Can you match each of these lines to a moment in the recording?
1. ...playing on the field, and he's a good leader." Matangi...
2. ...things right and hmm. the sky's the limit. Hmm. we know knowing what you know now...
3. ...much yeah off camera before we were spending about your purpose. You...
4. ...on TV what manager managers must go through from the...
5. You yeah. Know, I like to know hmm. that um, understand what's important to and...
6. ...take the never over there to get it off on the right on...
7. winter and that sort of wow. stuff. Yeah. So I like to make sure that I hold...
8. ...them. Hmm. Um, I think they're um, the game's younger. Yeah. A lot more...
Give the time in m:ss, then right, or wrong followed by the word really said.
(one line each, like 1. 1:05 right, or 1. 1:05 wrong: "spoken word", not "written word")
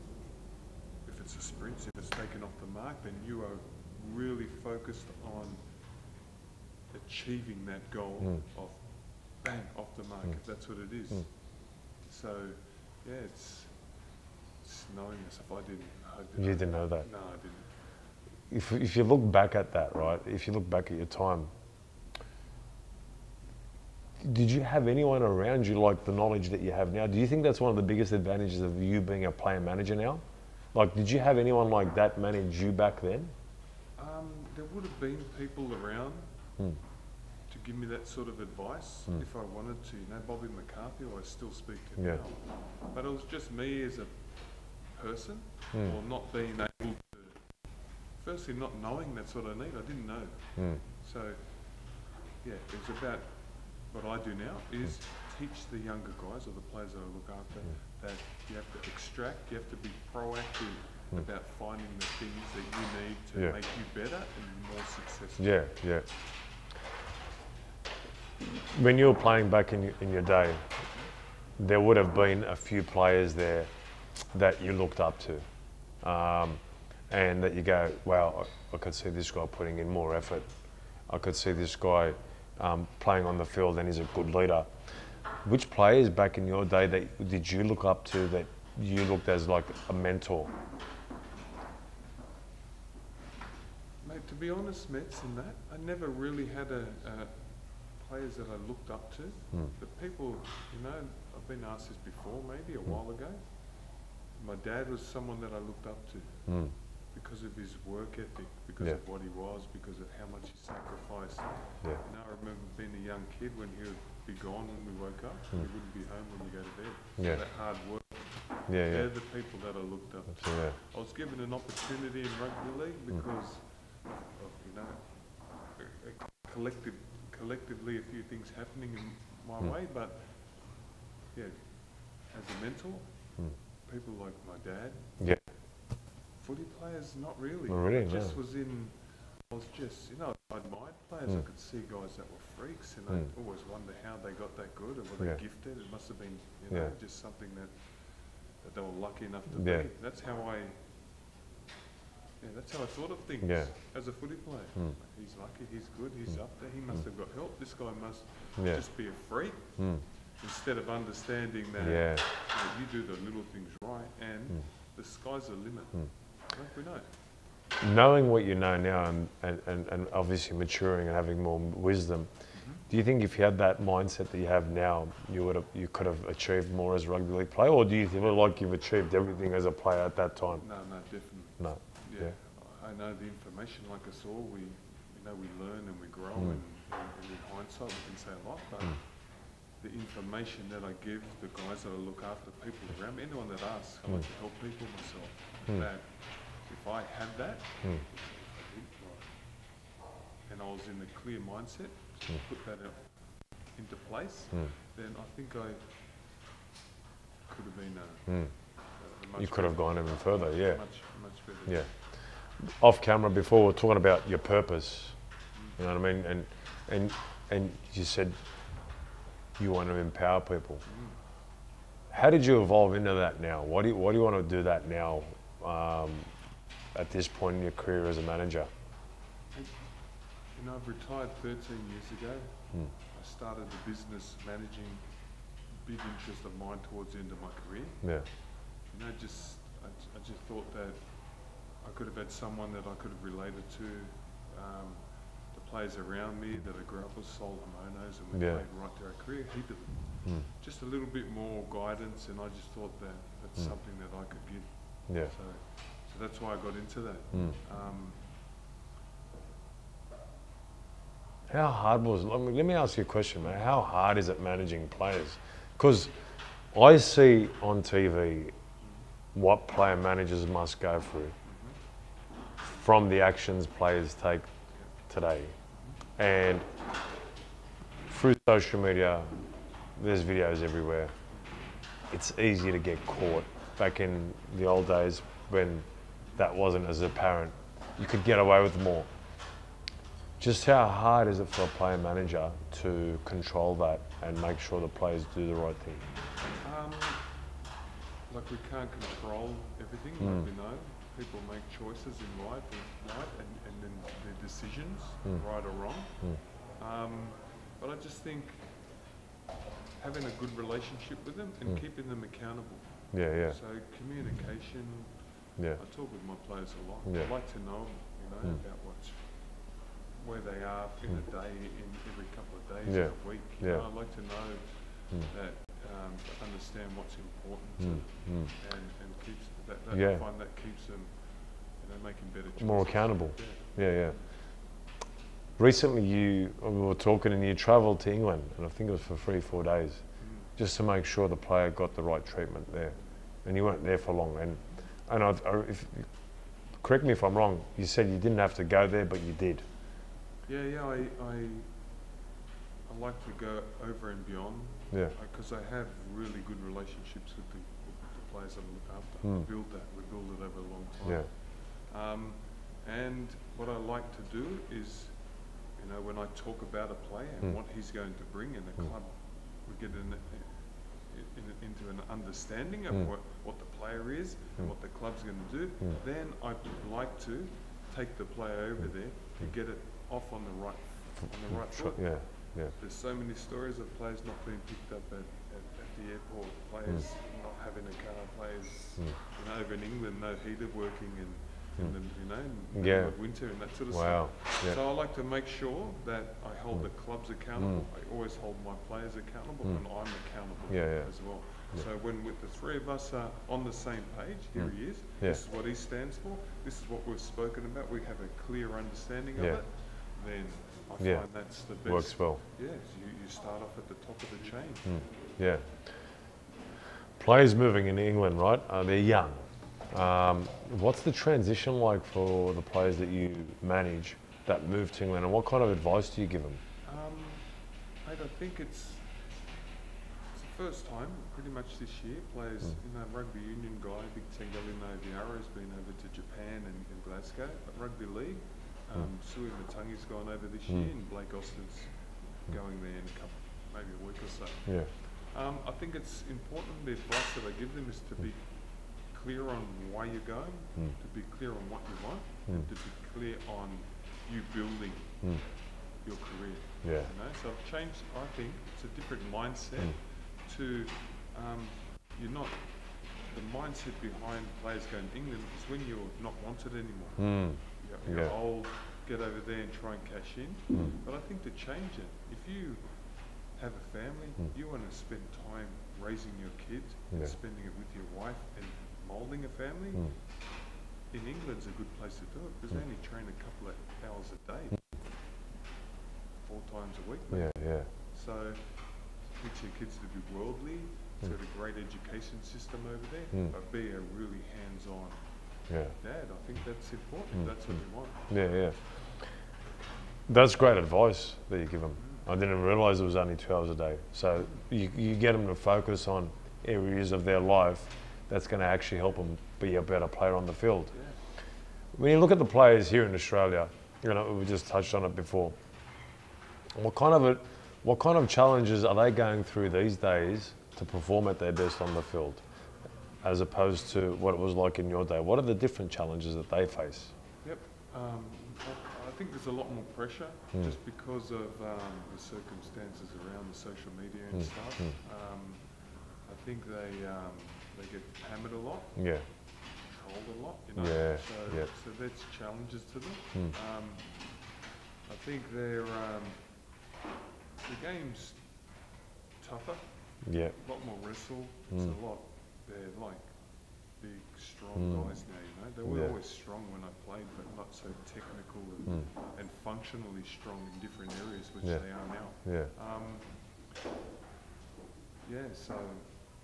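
1. 1:22 wrong: "Which", not "Matangi"
2. 2:43 right
3. 3:31 wrong: "talking", not "spending"
4. 4:27 wrong: "player", not "manager"
5. 5:23 right
6. 6:17 wrong: "player", not "never"
7. 6:33 right
8. 9:02 wrong: "tougher", not "younger".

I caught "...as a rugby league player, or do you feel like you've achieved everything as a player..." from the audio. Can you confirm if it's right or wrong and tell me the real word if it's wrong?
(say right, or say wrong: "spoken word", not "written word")
right.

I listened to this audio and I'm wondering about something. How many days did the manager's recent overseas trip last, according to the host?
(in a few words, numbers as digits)
3 or 4 days.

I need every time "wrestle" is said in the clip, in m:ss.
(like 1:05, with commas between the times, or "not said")
9:11.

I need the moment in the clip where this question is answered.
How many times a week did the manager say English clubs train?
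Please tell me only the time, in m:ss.
8:06.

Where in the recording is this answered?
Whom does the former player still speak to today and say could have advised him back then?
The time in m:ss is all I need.
0:40.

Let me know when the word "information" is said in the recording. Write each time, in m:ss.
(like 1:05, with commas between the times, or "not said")
3:03, 3:09.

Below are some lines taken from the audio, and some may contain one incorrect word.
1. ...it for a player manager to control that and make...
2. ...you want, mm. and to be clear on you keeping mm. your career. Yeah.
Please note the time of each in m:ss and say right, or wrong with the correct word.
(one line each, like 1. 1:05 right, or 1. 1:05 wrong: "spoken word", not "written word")
1. 4:51 right
2. 7:31 wrong: "building", not "keeping".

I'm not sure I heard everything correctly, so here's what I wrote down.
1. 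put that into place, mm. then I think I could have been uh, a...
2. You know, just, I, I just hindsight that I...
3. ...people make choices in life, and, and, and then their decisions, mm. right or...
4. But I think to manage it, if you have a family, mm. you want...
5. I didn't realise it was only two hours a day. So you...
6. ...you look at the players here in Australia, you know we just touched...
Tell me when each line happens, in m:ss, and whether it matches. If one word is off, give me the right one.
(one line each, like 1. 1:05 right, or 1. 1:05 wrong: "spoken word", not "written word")
1. 3:22 right
2. 3:58 wrong: "thought", not "hindsight"
3. 5:01 right
4. 7:51 wrong: "change", not "manage"
5. 8:22 right
6. 8:32 right.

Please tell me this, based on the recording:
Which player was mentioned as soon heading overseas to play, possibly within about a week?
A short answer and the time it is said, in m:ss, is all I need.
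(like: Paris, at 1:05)
Blake Austin, at 7:21.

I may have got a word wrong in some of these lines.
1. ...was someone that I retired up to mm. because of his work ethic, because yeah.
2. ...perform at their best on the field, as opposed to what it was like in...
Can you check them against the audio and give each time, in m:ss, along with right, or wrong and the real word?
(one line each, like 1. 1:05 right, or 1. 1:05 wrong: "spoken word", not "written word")
1. 1:44 wrong: "looked", not "retired"
2. 8:40 right.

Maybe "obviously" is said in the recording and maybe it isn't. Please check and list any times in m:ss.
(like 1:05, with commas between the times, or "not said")
2:50.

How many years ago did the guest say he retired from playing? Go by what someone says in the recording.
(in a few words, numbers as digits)
13.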